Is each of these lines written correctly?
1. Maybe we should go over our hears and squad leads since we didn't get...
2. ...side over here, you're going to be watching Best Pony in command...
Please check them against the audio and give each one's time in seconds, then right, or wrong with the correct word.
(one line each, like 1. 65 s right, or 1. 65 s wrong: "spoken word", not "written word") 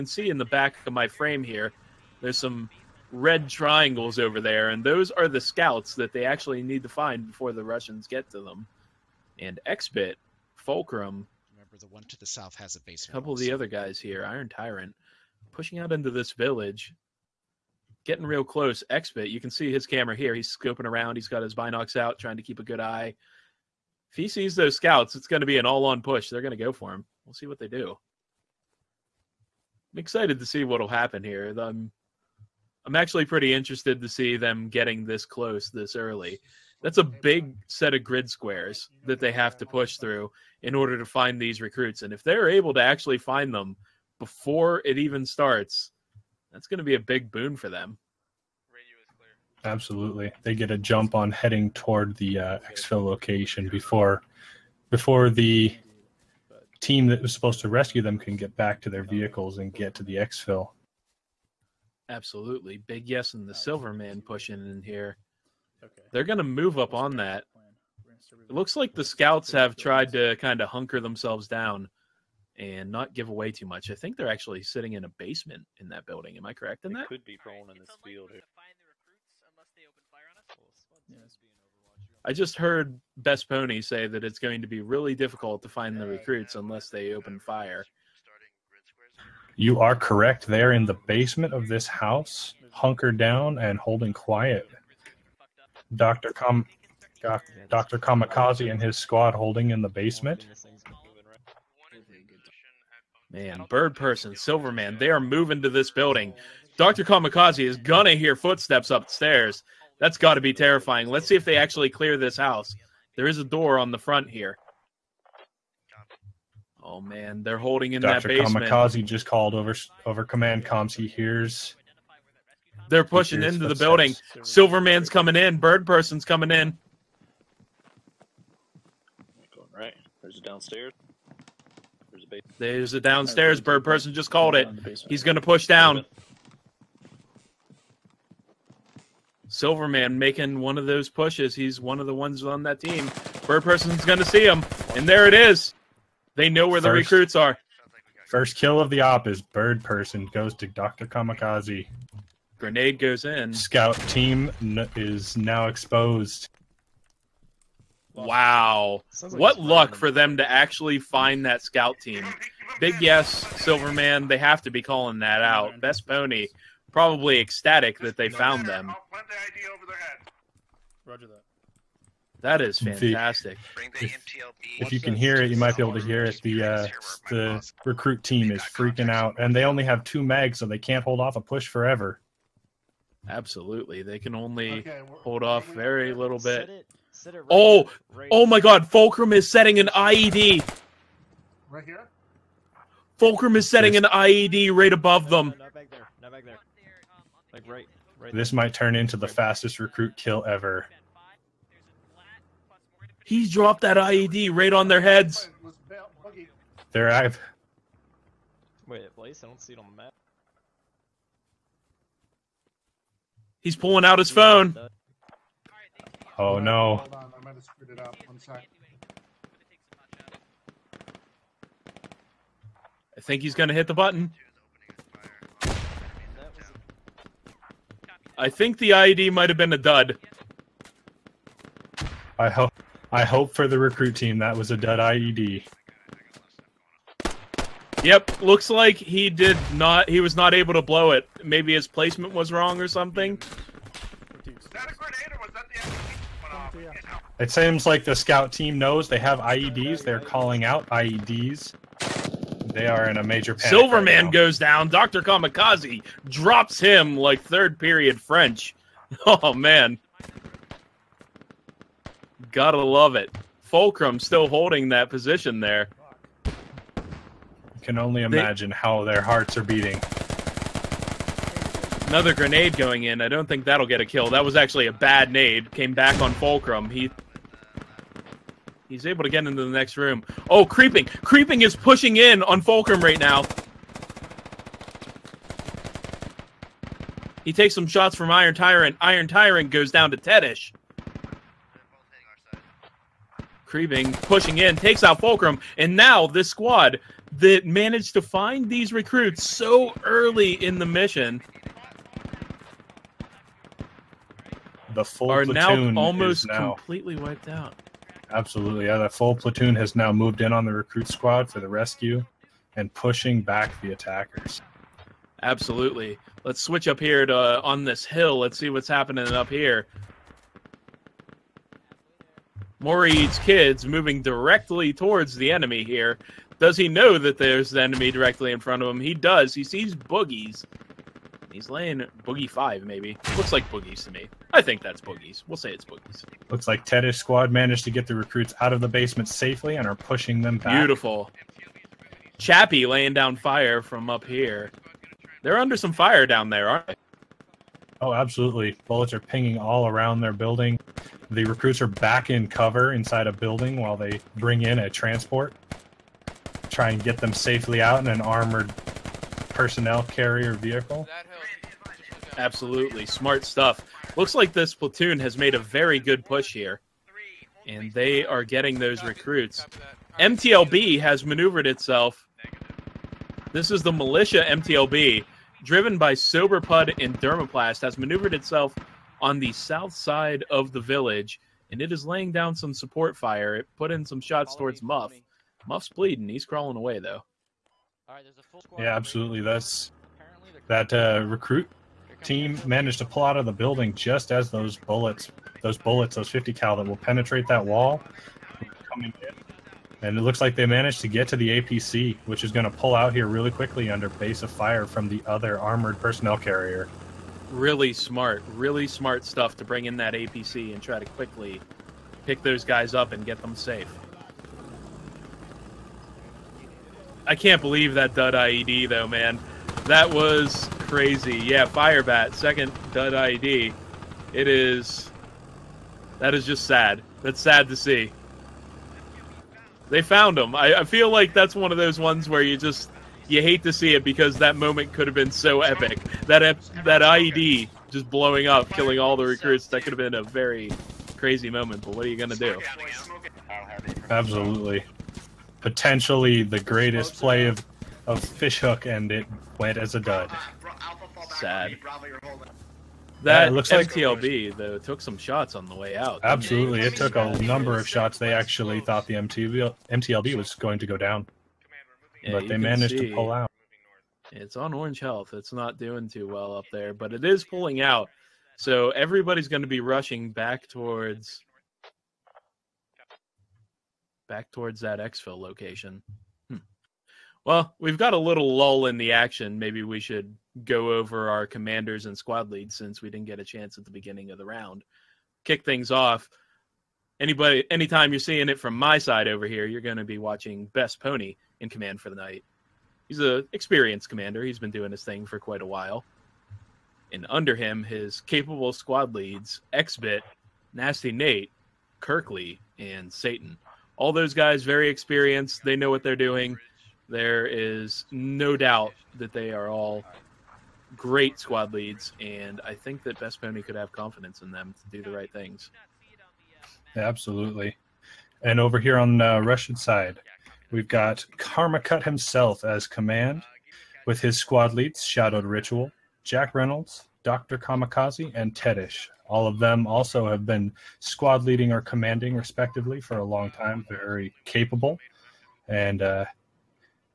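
1. 479 s wrong: "commanders", not "hears"
2. 488 s right.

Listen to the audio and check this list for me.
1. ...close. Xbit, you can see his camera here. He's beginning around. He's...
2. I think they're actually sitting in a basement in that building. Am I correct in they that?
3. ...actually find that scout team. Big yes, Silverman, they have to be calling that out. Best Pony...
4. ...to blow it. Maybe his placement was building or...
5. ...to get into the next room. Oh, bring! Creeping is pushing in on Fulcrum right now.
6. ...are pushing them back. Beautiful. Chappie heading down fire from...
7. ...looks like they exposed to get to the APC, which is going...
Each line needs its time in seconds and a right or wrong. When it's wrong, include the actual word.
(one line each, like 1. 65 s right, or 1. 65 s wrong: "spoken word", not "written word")
1. 18 s wrong: "scoping", not "beginning"
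2. 73 s right
3. 160 s right
4. 240 s wrong: "wrong", not "building"
5. 279 s wrong: "creeping", not "bring"
6. 339 s wrong: "laying", not "heading"
7. 400 s wrong: "managed", not "exposed".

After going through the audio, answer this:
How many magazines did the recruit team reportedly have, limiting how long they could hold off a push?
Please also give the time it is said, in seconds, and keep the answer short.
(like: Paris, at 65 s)
2, at 180 s.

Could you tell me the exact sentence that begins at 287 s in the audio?
He takes some shots from Iron Tyrant.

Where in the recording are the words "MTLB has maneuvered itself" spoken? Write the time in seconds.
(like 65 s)
370 s.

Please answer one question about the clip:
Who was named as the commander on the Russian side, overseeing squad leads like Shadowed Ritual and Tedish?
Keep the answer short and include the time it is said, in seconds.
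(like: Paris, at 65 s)
Karmakut, at 521 s.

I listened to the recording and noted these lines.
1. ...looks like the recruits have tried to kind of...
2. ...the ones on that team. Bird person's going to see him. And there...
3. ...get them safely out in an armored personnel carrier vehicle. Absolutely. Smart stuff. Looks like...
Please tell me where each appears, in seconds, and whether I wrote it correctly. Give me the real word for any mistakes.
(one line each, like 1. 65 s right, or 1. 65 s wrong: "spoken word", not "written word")
1. 68 s wrong: "scouts", not "recruits"
2. 142 s right
3. 357 s right.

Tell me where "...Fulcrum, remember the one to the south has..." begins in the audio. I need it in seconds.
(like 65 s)
10 s.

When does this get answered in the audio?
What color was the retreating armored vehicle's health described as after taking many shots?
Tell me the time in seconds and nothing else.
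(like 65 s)
464 s.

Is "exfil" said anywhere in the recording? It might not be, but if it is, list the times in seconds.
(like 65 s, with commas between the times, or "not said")
52 s, 60 s, 475 s.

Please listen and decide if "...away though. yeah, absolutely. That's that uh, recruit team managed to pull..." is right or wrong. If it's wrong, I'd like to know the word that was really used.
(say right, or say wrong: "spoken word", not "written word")
right.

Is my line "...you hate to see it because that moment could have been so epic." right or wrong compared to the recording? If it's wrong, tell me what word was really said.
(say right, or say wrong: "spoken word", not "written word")
right.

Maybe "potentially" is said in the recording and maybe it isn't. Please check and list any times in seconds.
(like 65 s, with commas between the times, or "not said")
445 s.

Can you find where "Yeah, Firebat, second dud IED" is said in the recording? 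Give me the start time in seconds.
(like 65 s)
421 s.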